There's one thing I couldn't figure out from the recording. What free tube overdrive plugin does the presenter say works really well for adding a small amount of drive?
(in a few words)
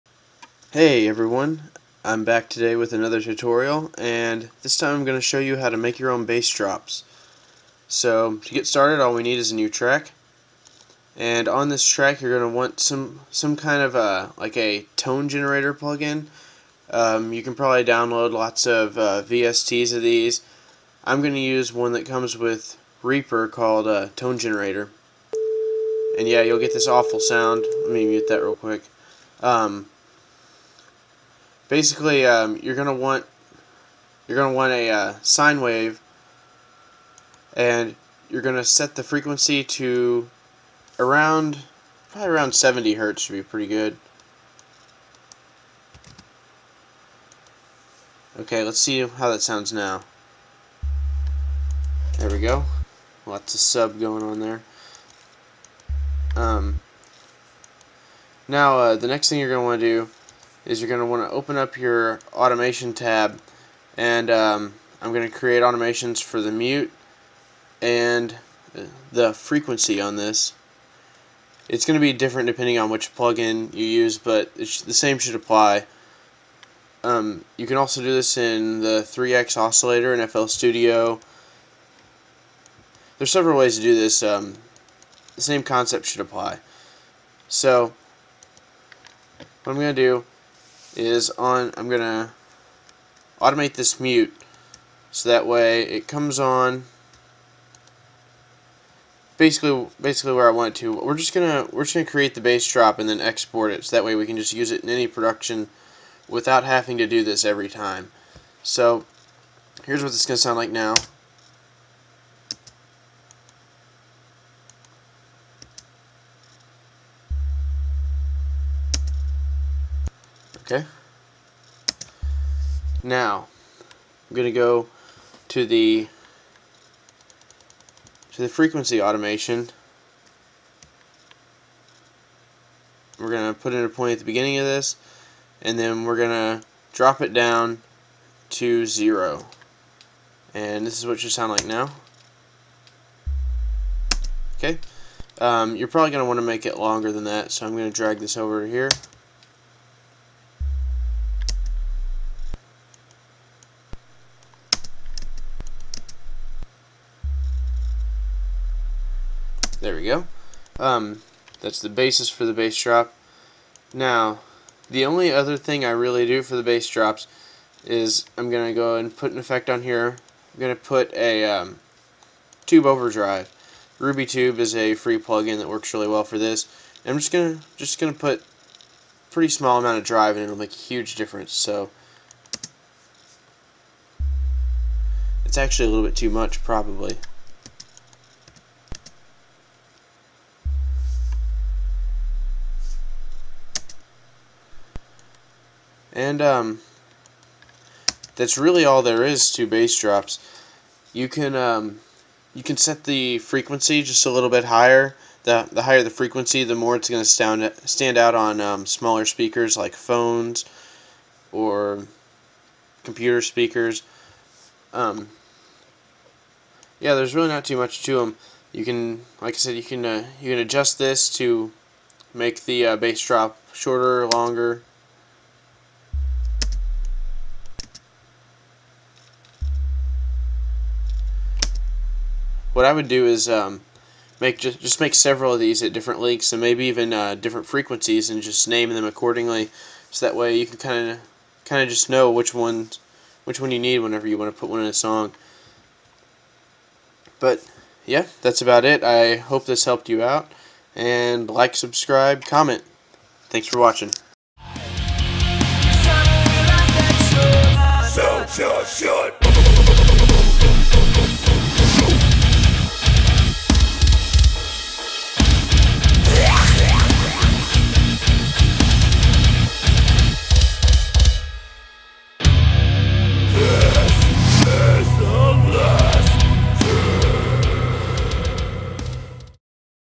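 Ruby Tube.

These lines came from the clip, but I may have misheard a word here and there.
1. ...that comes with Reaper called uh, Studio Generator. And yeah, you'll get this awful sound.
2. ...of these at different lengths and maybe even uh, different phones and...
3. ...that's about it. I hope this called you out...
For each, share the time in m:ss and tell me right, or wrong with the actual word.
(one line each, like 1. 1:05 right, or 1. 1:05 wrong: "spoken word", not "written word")
1. 0:21 wrong: "Tone", not "Studio"
2. 3:55 wrong: "frequencies", not "phones"
3. 4:08 wrong: "helped", not "called".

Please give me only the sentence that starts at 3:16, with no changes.
And um, that's really all there is to bass drops.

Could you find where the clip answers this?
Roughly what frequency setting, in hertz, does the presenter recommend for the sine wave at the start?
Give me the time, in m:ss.
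0:42.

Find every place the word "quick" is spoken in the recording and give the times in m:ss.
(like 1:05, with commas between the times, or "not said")
0:28.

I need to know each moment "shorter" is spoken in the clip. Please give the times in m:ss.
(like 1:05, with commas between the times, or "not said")
3:43.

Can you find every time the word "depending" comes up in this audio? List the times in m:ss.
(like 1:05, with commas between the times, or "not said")
1:12.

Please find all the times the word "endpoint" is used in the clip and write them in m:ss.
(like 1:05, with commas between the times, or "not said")
not said.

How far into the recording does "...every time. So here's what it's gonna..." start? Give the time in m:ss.
1:47.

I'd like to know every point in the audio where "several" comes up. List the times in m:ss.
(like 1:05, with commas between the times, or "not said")
1:23, 3:55.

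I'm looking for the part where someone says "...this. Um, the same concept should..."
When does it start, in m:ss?
1:23.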